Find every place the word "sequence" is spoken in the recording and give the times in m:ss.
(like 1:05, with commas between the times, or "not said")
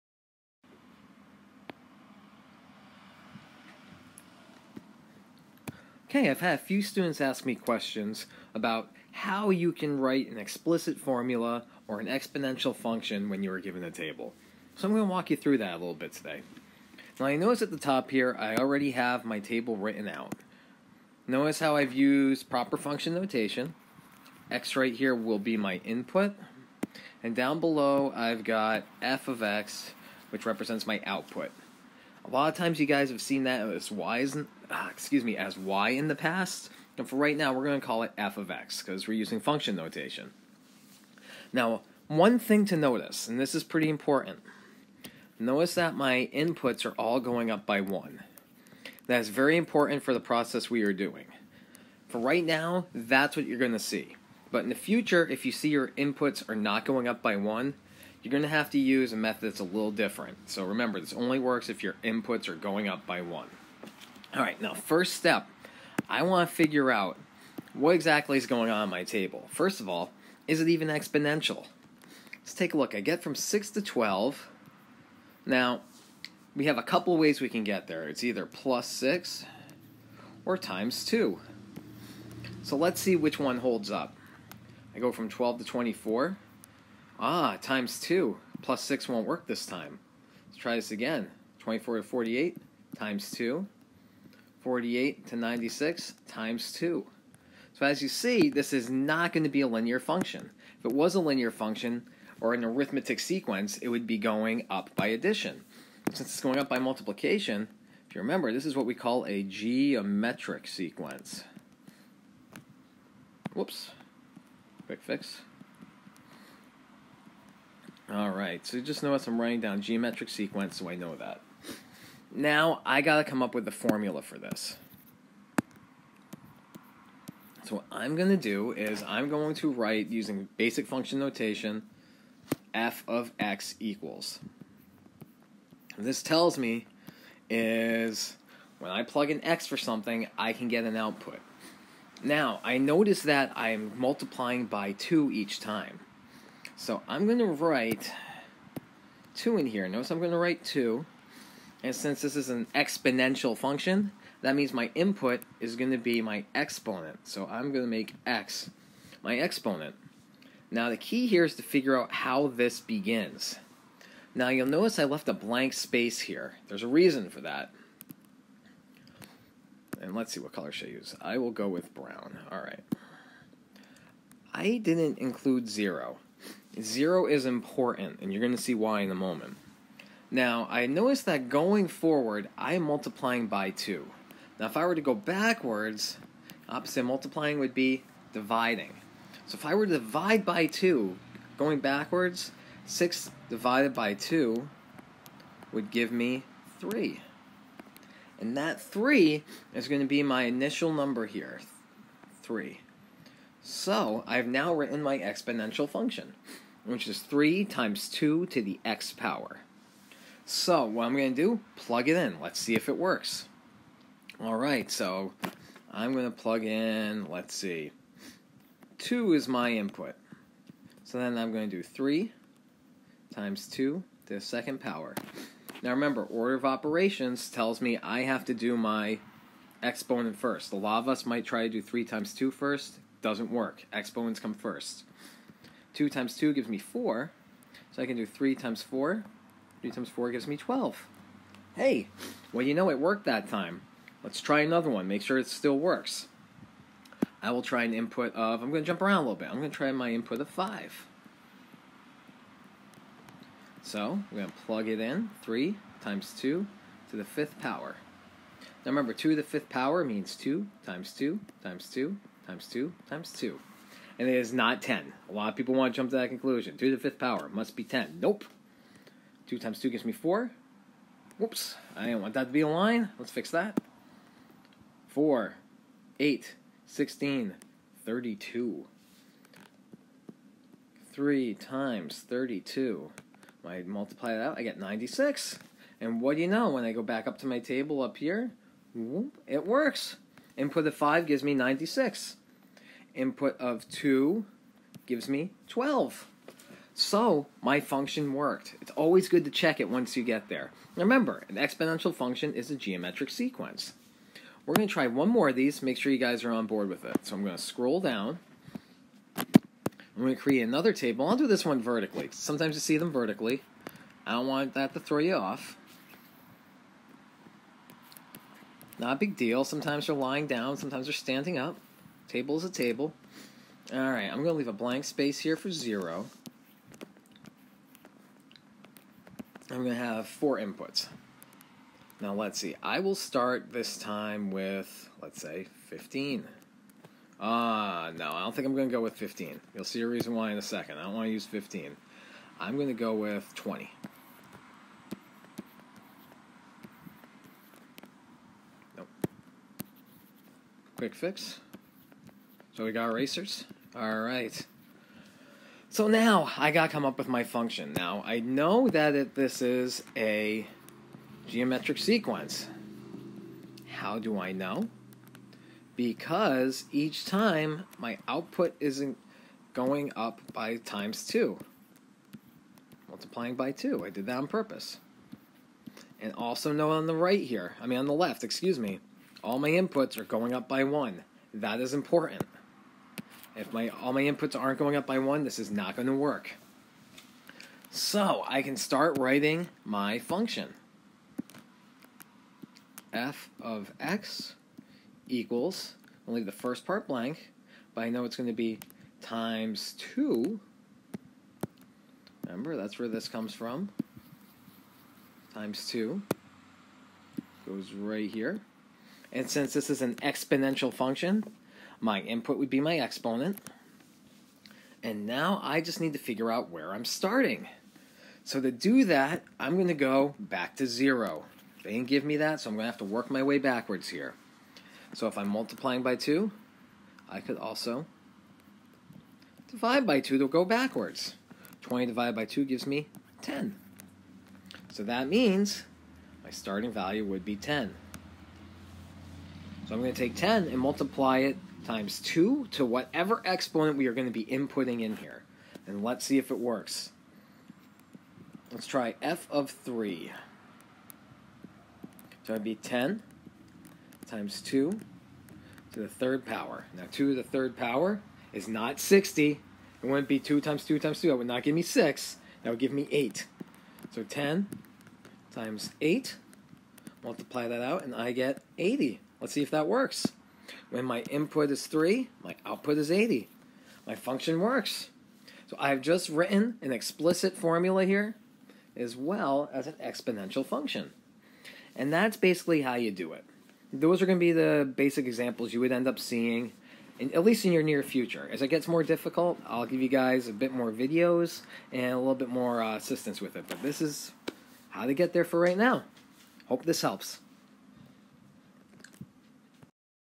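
1:43, 1:50, 2:00, 5:03, 6:01.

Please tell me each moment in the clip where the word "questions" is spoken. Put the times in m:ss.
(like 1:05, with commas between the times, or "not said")
0:07.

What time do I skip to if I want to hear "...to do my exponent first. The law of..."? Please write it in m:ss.
3:48.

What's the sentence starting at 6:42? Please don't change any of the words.
Remember, that's where this comes from.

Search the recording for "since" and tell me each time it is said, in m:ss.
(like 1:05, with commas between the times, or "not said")
1:46, 2:31, 6:49.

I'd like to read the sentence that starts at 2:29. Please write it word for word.
Notice I'm going to write 2.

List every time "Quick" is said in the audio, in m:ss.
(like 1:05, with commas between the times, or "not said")
1:54, 5:50.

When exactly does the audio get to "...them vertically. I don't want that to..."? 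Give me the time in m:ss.
5:12.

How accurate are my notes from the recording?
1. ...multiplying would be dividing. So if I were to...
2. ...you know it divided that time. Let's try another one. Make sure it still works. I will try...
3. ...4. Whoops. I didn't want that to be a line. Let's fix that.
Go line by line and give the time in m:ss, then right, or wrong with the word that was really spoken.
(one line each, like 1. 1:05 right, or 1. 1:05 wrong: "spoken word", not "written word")
1. 3:07 right
2. 4:02 wrong: "worked", not "divided"
3. 4:30 right.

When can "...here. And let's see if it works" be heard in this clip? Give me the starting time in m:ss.
7:25.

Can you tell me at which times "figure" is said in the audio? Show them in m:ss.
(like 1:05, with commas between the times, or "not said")
1:06, 2:41, 6:56.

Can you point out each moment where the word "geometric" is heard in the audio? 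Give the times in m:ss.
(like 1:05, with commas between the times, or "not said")
1:49, 1:59, 5:02, 6:01.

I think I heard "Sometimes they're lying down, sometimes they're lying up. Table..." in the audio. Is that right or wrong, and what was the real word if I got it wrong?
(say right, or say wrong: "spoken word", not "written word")
wrong: "standing", not "lying".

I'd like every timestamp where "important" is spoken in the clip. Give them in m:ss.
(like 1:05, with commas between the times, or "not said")
0:43, 0:49, 2:57, 6:21.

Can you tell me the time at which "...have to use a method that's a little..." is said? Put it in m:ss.
0:58.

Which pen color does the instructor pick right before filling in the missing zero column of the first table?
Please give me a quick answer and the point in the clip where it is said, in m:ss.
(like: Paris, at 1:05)
brown, at 2:51.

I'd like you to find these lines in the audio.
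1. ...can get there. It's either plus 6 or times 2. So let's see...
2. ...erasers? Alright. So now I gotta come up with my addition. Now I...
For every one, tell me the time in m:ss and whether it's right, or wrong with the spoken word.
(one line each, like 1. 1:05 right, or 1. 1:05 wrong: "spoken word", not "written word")
1. 1:17 right
2. 5:53 wrong: "function", not "addition".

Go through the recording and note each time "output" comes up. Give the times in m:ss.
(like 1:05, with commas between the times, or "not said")
0:31, 2:20, 6:08, 7:52.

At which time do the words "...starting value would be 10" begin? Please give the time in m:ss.
7:16.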